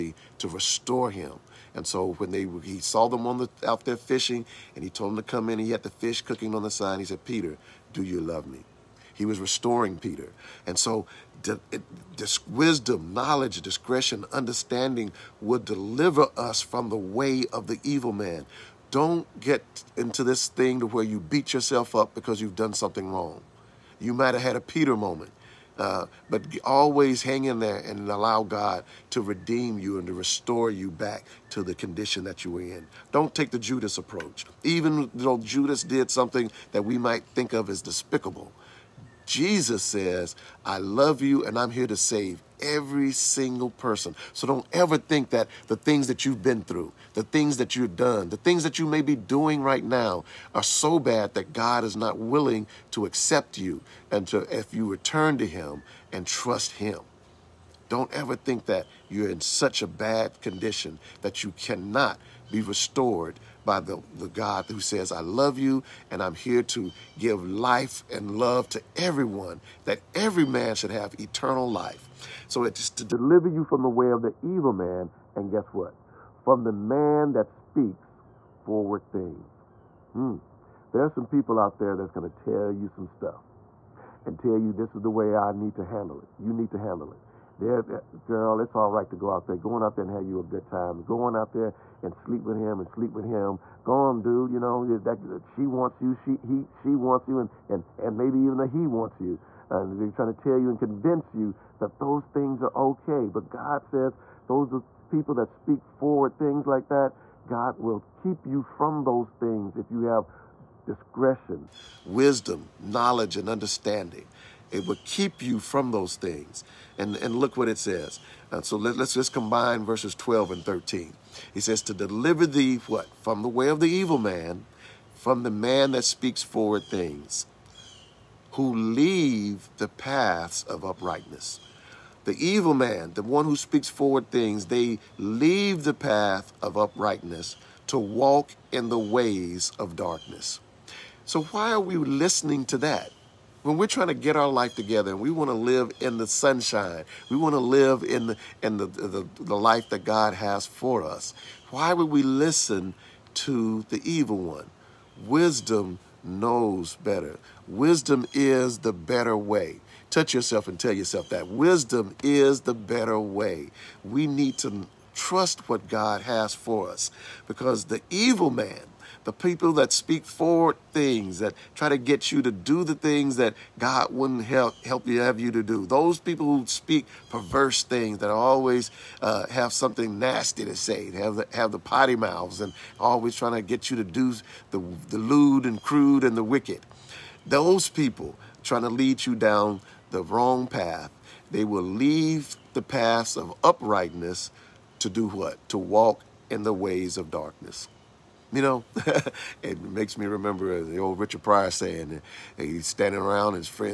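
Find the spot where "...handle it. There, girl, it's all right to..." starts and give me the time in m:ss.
1:26.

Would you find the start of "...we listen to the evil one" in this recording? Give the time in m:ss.
2:32.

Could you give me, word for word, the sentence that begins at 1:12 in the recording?
So it's to deliver you from the way of the evil man, and guess what?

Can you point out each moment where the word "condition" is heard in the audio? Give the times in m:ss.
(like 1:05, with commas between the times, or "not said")
0:31, 1:00.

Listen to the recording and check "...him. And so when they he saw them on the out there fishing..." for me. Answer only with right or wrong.
right.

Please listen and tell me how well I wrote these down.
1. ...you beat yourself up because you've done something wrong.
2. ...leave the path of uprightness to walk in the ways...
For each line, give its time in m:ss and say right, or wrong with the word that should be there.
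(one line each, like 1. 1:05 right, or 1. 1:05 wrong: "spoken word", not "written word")
1. 0:21 right
2. 2:15 right.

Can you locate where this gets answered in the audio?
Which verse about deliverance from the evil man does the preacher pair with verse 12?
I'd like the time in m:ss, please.
2:00.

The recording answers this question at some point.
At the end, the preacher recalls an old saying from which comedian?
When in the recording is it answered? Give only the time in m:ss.
3:21.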